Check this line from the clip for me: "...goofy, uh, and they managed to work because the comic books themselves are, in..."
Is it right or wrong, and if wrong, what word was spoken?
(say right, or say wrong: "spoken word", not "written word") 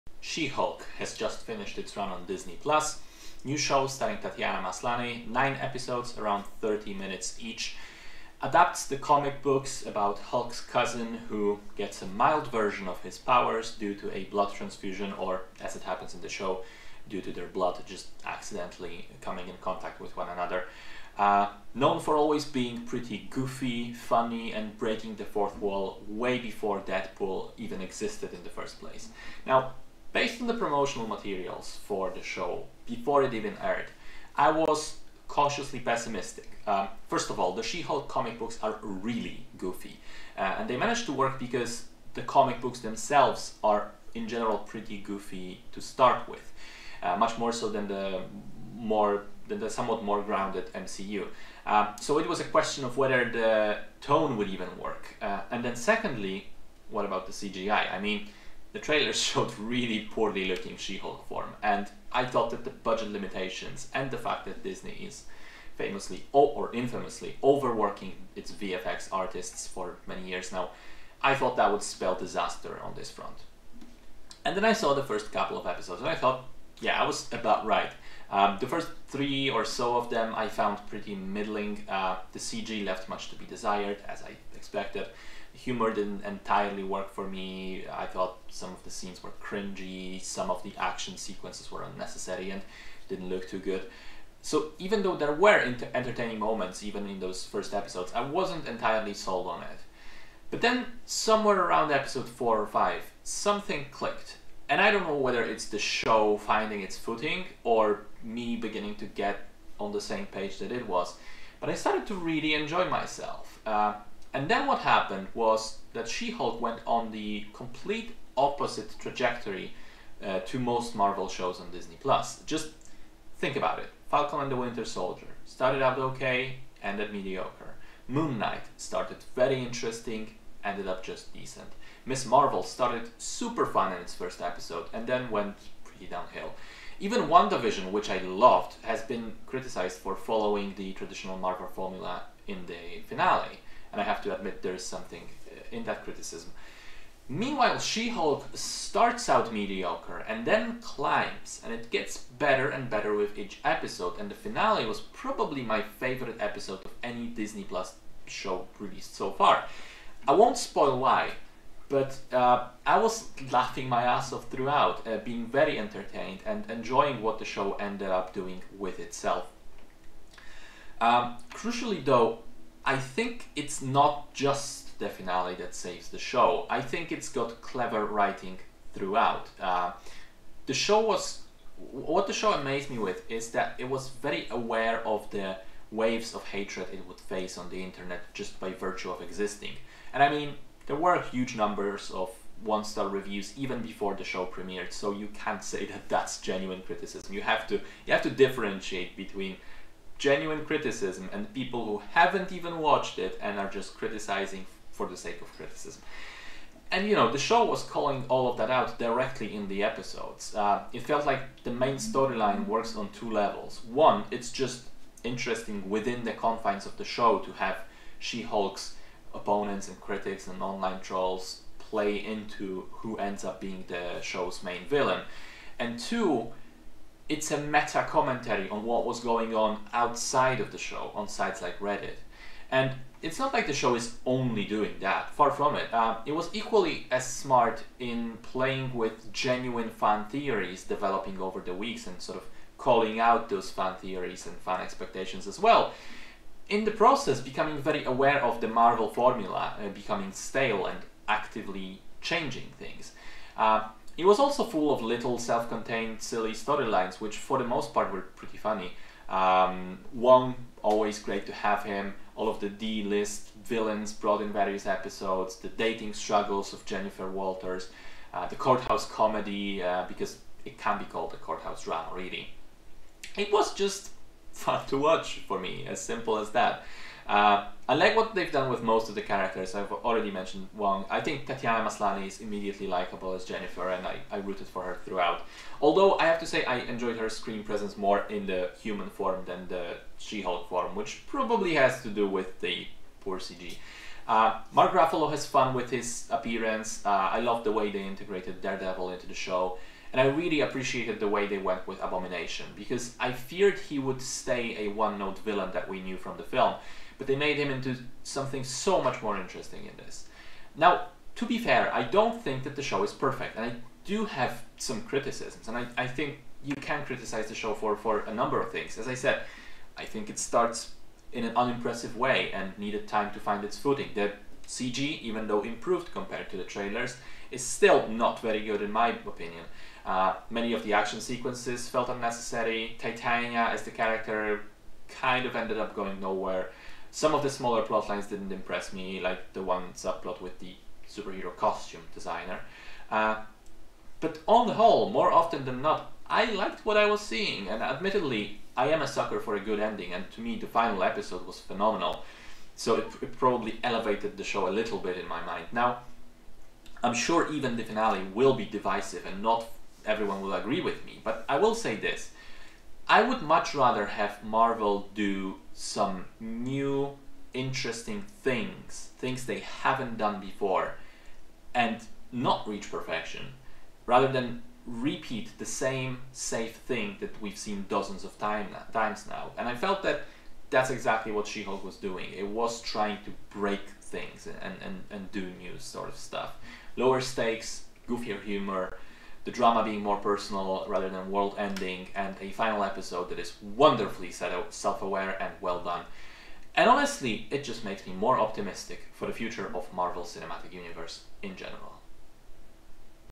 right.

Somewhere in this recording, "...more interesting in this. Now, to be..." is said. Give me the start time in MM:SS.
05:09.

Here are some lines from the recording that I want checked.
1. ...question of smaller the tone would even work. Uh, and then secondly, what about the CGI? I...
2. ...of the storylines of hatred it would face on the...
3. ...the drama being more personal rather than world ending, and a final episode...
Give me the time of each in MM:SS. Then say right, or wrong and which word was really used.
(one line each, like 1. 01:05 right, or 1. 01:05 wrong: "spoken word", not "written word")
1. 00:52 wrong: "whether", not "smaller"
2. 03:05 wrong: "waves", not "storylines"
3. 06:29 right.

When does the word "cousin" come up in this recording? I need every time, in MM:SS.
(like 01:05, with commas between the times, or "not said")
00:10.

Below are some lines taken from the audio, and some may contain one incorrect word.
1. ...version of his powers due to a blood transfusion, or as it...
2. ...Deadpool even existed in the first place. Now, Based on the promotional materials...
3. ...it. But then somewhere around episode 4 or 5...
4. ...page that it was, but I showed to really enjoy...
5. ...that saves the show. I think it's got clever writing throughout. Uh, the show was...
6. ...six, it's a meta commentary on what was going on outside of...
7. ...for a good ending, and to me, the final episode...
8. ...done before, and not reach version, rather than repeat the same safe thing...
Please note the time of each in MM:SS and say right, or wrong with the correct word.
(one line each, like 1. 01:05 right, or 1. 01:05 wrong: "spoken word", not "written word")
1. 00:12 right
2. 00:26 right
3. 01:39 right
4. 01:50 wrong: "started", not "showed"
5. 02:55 right
6. 03:45 wrong: "two", not "six"
7. 05:49 right
8. 06:10 wrong: "perfection", not "version".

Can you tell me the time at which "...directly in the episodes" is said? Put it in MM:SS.
03:28.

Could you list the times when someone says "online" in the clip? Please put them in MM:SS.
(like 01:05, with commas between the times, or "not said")
03:40.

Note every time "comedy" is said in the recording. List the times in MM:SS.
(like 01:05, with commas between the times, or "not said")
04:29.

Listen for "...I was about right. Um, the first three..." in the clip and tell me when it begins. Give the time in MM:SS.
01:17.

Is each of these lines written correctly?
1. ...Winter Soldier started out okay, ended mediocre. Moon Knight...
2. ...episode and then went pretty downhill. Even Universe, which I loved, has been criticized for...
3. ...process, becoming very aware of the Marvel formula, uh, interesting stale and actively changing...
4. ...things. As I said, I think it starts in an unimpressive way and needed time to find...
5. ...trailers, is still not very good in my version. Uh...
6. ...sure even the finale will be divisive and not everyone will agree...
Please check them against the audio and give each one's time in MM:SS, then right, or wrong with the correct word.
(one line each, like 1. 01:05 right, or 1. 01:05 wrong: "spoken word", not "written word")
1. 02:04 right
2. 02:14 wrong: "WandaVision", not "Universe"
3. 04:06 wrong: "becoming", not "interesting"
4. 05:18 right
5. 05:26 wrong: "opinion", not "version"
6. 05:57 right.